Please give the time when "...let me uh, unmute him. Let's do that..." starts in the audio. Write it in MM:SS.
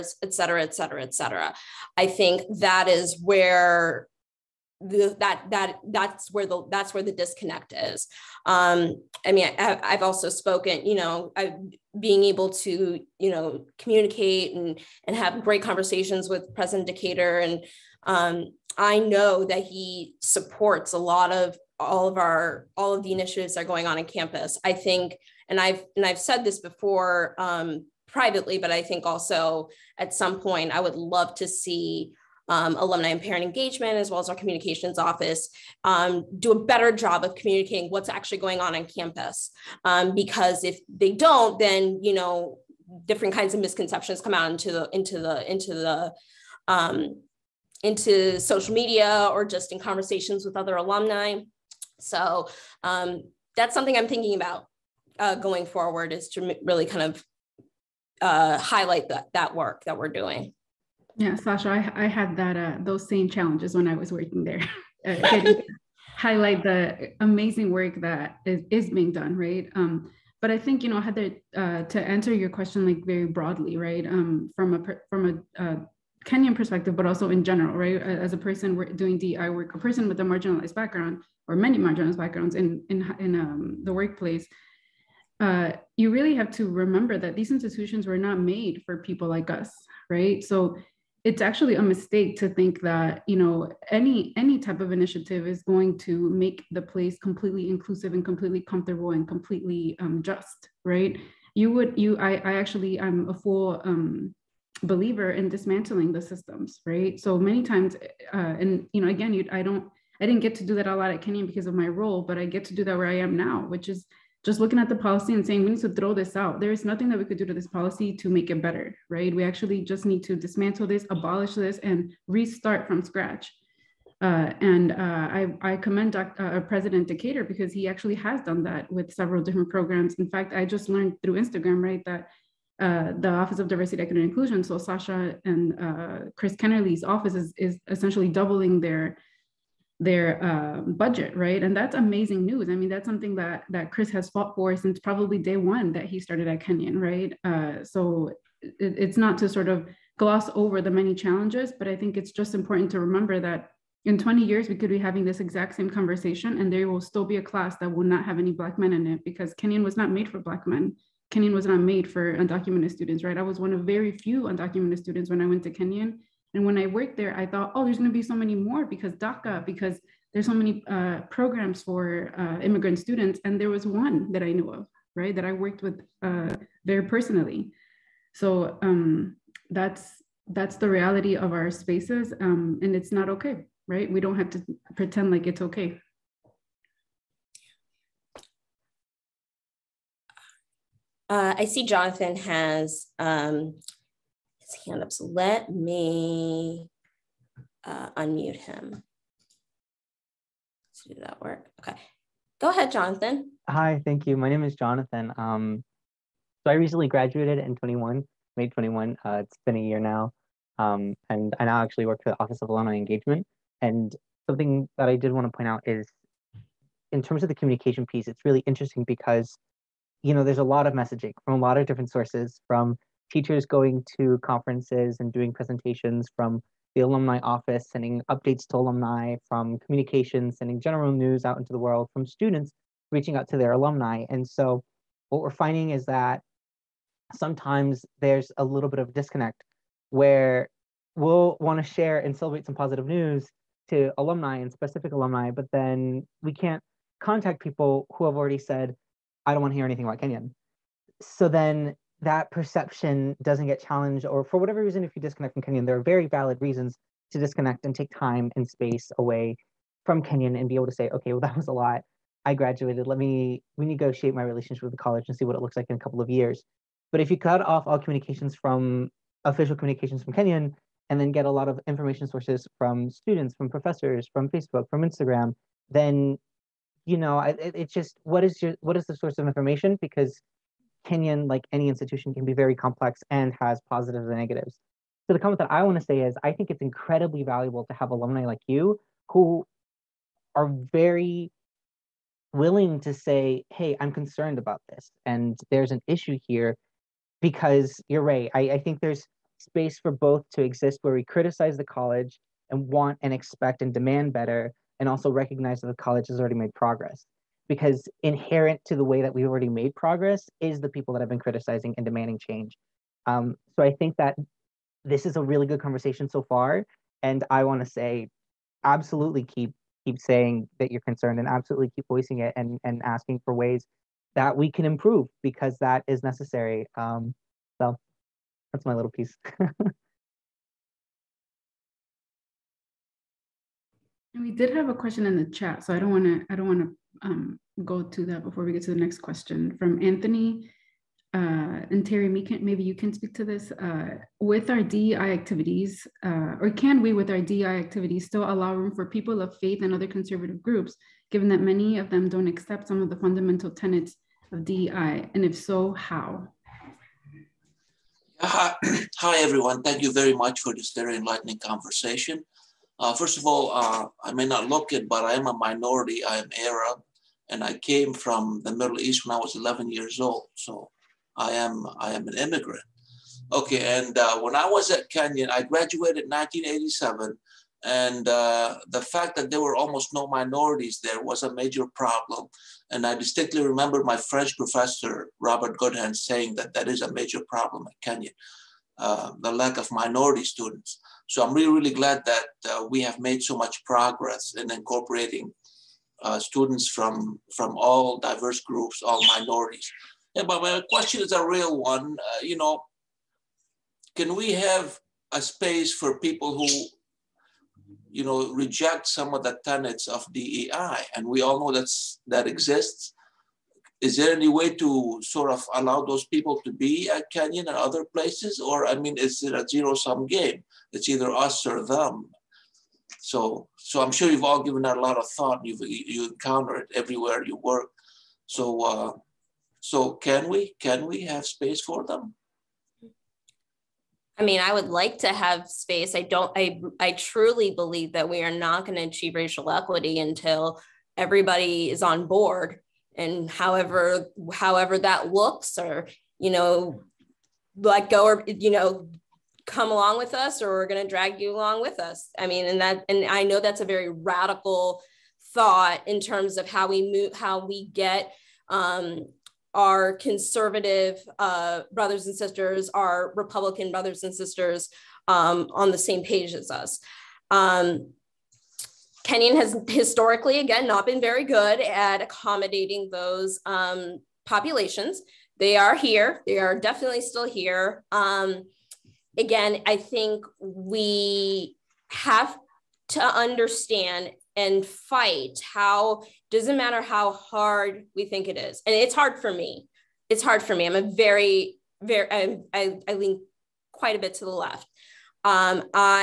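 03:15.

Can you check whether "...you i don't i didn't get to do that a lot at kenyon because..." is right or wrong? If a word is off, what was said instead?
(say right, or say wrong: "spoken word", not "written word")
right.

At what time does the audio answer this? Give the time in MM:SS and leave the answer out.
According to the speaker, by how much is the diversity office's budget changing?
02:18.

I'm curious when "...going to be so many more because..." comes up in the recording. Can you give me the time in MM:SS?
02:47.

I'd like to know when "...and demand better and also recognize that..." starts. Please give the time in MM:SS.
05:03.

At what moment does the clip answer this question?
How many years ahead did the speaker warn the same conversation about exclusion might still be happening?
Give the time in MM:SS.
02:34.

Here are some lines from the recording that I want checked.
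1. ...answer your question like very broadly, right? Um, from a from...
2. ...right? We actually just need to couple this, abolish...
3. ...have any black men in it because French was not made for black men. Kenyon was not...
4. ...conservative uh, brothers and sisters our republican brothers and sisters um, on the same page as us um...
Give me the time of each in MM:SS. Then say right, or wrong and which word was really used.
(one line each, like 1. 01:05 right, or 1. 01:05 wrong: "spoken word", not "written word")
1. 01:11 right
2. 01:59 wrong: "dismantle", not "couple"
3. 02:38 wrong: "Kenyon", not "French"
4. 07:40 right.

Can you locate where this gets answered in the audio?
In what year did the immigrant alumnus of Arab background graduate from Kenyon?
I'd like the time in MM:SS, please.
06:16.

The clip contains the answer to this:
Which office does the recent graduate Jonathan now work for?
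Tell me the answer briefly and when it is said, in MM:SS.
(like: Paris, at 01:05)
Office of Alumni Engagement, at 03:32.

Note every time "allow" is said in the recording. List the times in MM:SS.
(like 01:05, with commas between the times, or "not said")
05:48, 06:55.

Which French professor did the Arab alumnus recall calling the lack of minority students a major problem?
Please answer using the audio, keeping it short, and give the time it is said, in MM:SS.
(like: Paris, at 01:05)
Robert Goodhand, at 06:25.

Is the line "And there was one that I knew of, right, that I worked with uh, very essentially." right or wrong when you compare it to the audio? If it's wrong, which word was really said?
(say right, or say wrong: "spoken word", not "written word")
wrong: "personally", not "essentially".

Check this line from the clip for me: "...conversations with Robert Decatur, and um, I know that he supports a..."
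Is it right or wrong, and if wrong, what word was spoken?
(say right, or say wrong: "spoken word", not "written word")
wrong: "President", not "Robert".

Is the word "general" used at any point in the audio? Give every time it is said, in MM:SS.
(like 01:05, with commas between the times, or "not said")
01:17, 03:50.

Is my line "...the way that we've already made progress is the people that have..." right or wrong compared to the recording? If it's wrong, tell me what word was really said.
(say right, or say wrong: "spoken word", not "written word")
right.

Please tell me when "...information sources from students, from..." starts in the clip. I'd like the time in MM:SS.
04:31.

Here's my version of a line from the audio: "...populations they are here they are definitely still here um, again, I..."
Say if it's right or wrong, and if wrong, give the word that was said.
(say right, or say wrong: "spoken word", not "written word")
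right.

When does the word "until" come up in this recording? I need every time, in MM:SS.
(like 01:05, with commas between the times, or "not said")
07:20.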